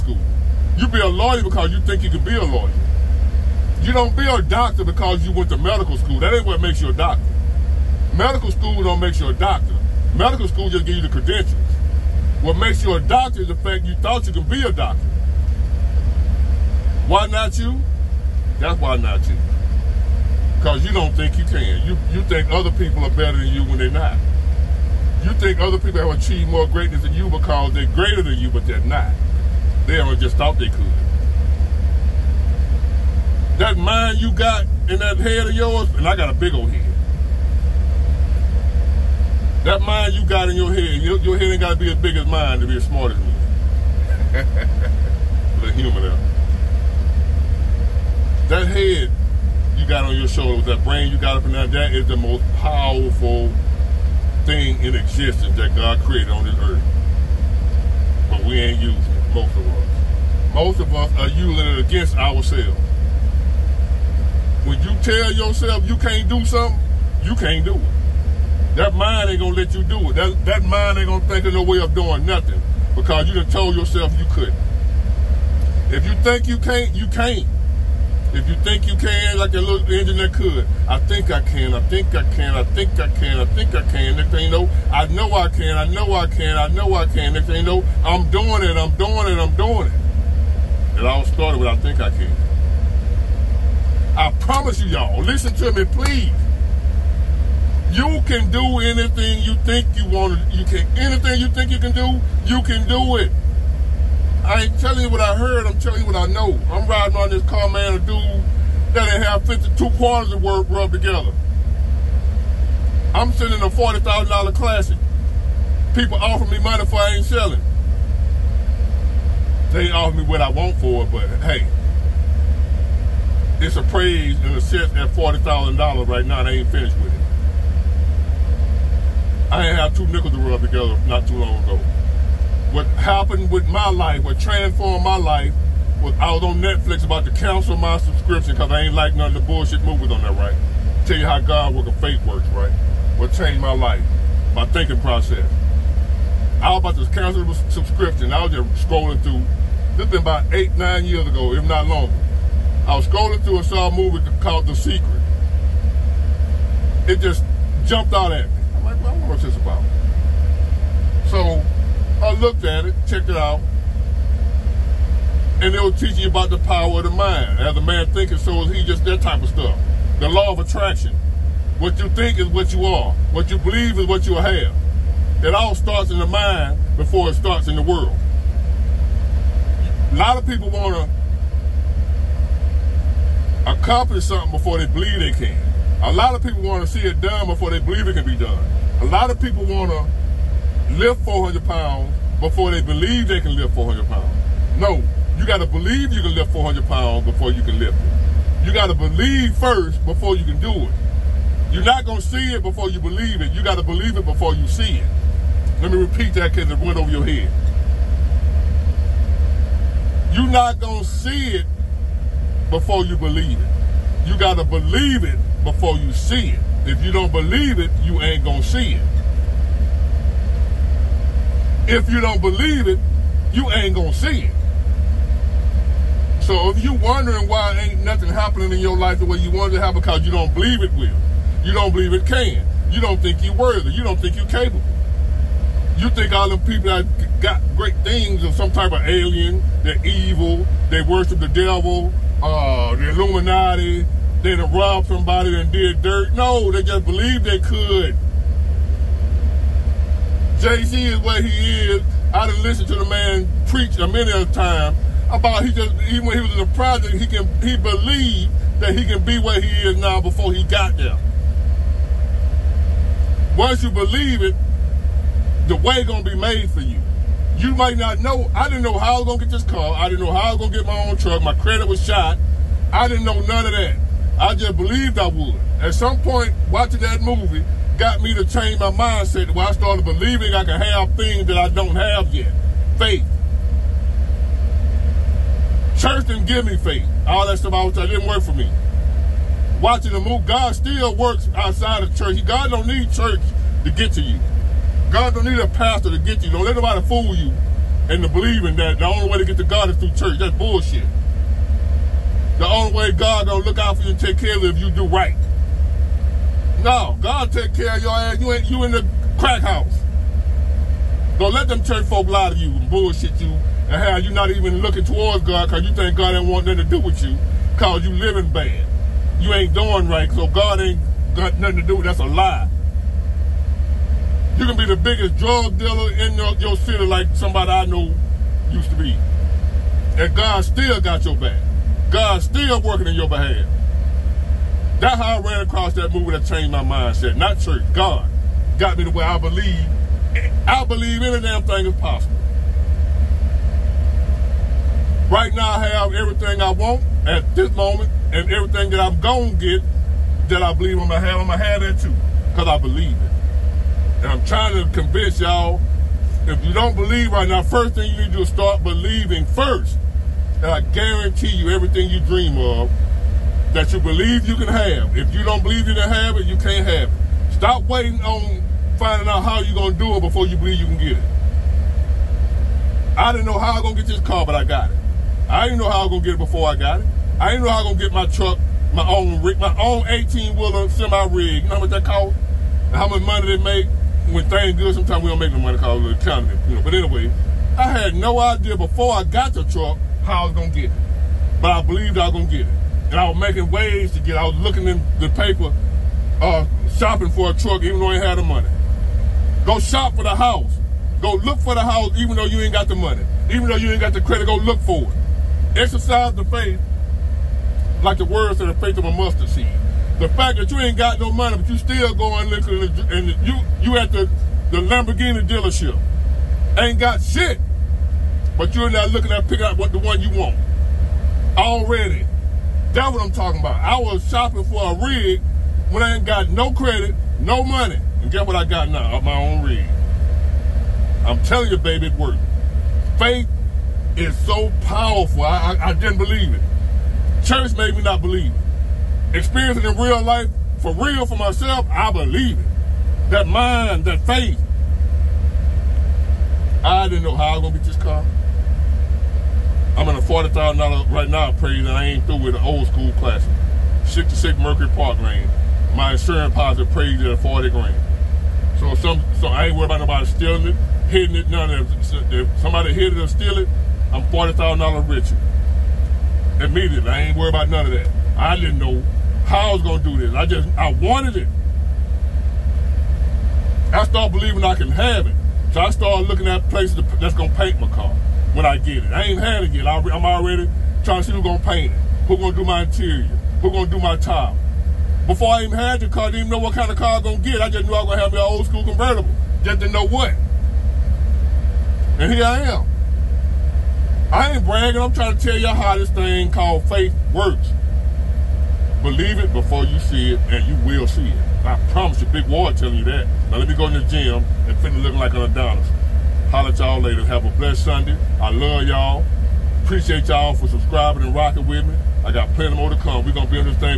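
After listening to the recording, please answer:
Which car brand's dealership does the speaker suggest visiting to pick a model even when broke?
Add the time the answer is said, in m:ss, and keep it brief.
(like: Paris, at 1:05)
Lamborghini, at 6:54.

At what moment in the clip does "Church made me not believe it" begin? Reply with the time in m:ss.
7:17.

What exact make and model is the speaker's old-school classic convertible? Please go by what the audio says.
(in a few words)
66 Mercury Park Lane.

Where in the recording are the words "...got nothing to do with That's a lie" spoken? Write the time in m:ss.
5:21.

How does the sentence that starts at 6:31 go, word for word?
But I believed I was gonna get it.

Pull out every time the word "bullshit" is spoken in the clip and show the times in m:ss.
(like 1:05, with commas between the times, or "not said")
2:19, 5:00, 5:12.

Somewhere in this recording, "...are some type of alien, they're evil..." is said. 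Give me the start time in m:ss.
3:58.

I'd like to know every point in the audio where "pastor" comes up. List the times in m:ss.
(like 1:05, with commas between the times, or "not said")
4:55.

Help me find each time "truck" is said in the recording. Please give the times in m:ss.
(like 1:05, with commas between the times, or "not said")
4:31, 6:18, 6:29, 6:37.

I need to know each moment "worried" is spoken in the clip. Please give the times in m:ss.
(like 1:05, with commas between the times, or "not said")
7:39, 7:47.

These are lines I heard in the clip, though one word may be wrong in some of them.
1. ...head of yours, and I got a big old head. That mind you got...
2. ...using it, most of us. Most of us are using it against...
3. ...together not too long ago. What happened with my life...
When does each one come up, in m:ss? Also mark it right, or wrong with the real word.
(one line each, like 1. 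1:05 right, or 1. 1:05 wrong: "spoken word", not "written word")
1. 0:35 right
2. 0:58 right
3. 2:10 right.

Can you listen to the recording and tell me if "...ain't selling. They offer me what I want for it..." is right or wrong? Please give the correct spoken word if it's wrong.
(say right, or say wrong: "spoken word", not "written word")
right.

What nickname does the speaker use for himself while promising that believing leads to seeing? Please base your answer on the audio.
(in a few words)
Big Ward.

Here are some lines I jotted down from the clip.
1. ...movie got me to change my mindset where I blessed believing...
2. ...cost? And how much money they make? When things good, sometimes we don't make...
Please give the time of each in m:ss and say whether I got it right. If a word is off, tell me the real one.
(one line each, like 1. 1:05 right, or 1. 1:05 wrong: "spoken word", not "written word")
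1. 4:37 wrong: "started", not "blessed"
2. 6:22 right.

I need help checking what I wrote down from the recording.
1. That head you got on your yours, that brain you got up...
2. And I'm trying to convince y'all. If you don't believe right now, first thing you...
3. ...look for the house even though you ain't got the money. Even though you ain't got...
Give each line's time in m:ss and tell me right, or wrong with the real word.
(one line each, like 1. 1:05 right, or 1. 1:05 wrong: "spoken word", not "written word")
1. 0:48 wrong: "shoulders", not "yours"
2. 5:54 right
3. 6:41 right.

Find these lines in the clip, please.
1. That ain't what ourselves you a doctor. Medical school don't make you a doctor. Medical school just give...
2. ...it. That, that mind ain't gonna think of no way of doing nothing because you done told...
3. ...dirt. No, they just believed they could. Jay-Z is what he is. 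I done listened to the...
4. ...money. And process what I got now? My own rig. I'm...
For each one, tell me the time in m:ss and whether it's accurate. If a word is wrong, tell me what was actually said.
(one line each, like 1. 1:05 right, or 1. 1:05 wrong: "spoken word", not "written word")
1. 0:06 wrong: "makes", not "ourselves"
2. 1:10 right
3. 4:06 right
4. 7:07 wrong: "guess", not "process".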